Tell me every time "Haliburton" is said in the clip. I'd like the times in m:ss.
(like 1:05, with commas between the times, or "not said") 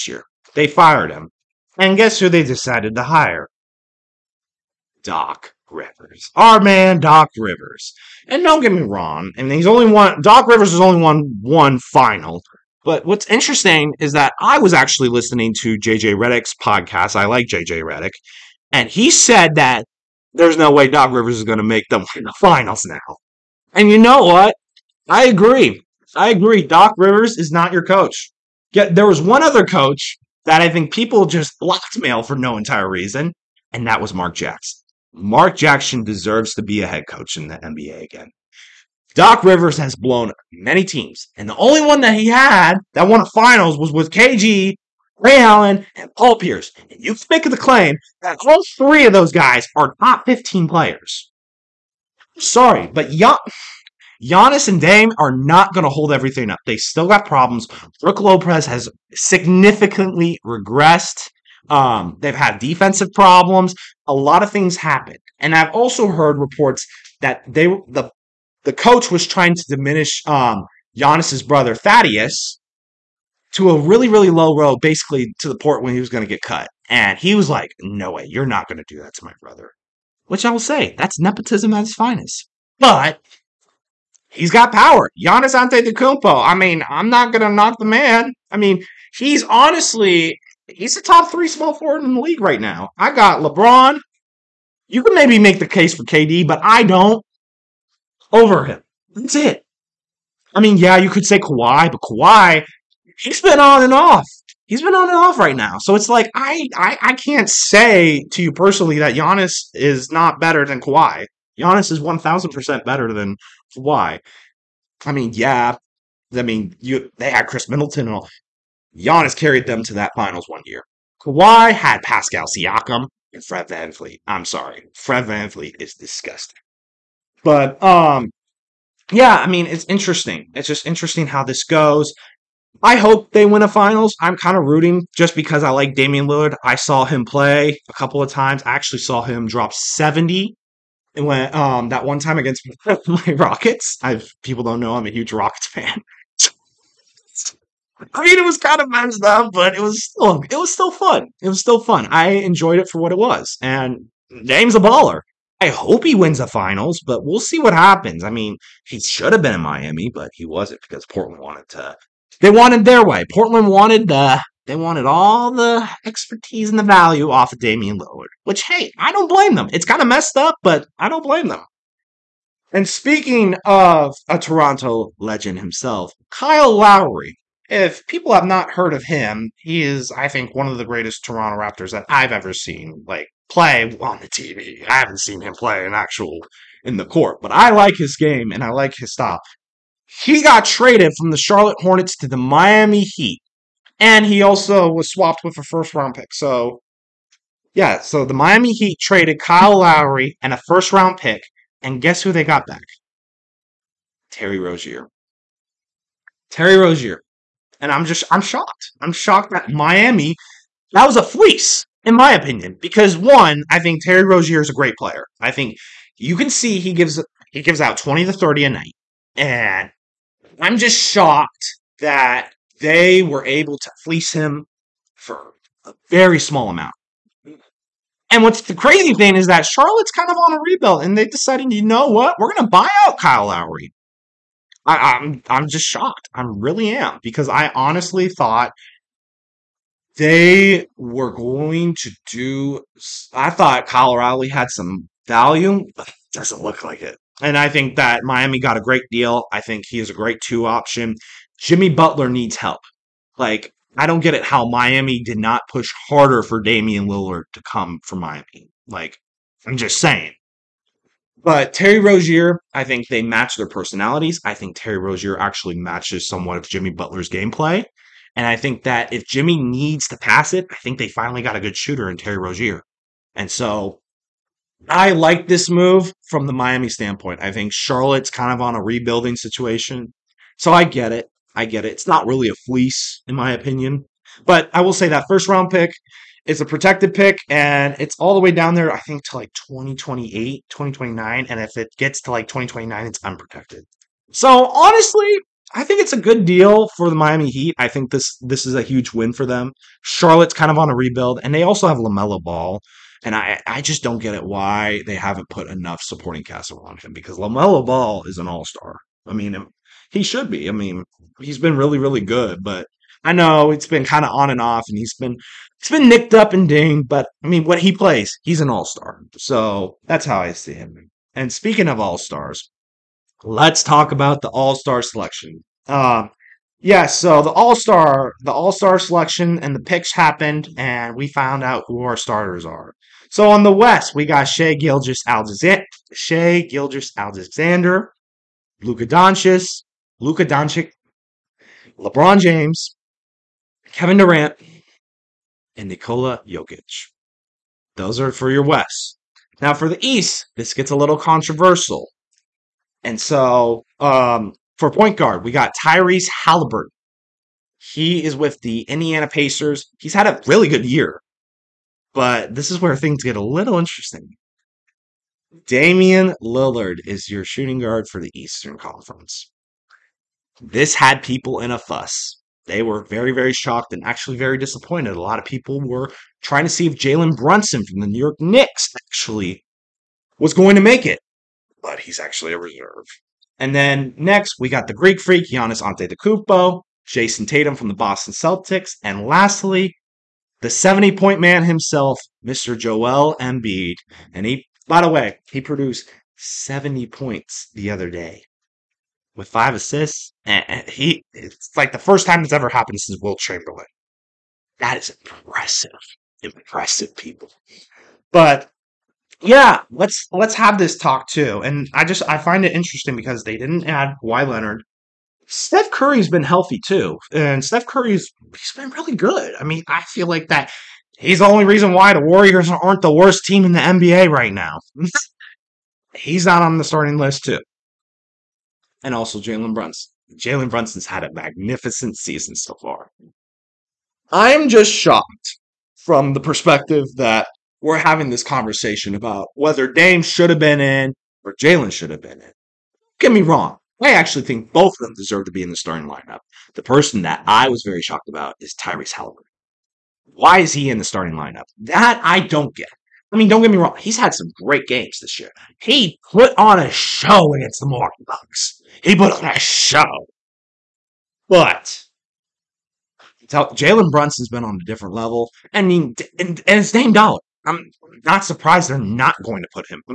5:56, 7:29.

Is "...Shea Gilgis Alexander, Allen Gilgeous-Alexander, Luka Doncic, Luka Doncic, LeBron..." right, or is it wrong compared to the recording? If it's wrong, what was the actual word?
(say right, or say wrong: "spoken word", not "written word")
wrong: "Shai", not "Allen".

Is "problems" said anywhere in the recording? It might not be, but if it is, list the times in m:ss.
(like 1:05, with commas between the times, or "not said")
0:57, 1:03.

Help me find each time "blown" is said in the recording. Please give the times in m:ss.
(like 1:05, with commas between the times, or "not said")
0:39.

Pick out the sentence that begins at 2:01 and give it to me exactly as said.
Kawhi had Pascal Siakam and Fred VanVleet.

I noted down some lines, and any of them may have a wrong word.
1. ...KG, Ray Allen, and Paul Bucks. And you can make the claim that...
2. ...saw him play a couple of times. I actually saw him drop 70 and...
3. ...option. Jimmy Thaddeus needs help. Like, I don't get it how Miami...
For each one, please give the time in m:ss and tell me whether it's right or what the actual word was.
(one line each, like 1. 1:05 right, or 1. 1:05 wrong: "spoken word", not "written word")
1. 0:44 wrong: "Pierce", not "Bucks"
2. 2:16 right
3. 4:10 wrong: "Butler", not "Thaddeus".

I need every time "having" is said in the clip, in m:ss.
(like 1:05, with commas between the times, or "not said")
7:17.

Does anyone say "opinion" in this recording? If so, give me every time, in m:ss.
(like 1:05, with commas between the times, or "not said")
3:32, 4:43.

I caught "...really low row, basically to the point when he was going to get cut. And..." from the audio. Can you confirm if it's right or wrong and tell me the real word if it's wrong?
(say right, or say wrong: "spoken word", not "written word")
right.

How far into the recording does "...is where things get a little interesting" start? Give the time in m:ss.
6:02.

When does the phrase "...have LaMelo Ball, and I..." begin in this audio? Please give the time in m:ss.
5:01.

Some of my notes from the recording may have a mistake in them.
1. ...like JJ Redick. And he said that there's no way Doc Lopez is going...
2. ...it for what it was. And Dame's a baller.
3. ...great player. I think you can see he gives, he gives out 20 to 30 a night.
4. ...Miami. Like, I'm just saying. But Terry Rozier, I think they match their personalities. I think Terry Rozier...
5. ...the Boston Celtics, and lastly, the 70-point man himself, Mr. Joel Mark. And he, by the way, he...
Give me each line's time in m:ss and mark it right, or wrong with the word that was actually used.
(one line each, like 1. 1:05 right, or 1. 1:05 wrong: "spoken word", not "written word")
1. 0:17 wrong: "Rivers", not "Lopez"
2. 2:32 right
3. 3:34 right
4. 4:18 right
5. 6:27 wrong: "Embiid", not "Mark".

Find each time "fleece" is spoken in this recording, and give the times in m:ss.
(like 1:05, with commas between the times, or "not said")
3:31, 3:44, 4:42.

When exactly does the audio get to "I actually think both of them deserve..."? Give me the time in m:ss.
7:24.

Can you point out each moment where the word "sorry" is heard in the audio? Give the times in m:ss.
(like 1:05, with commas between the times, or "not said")
0:52, 2:04.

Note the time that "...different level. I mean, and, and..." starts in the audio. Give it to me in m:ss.
7:44.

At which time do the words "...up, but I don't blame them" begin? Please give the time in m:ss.
2:50.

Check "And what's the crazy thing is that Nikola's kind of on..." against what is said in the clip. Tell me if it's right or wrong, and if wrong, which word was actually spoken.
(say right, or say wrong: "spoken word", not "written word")
wrong: "Charlotte", not "Nikola".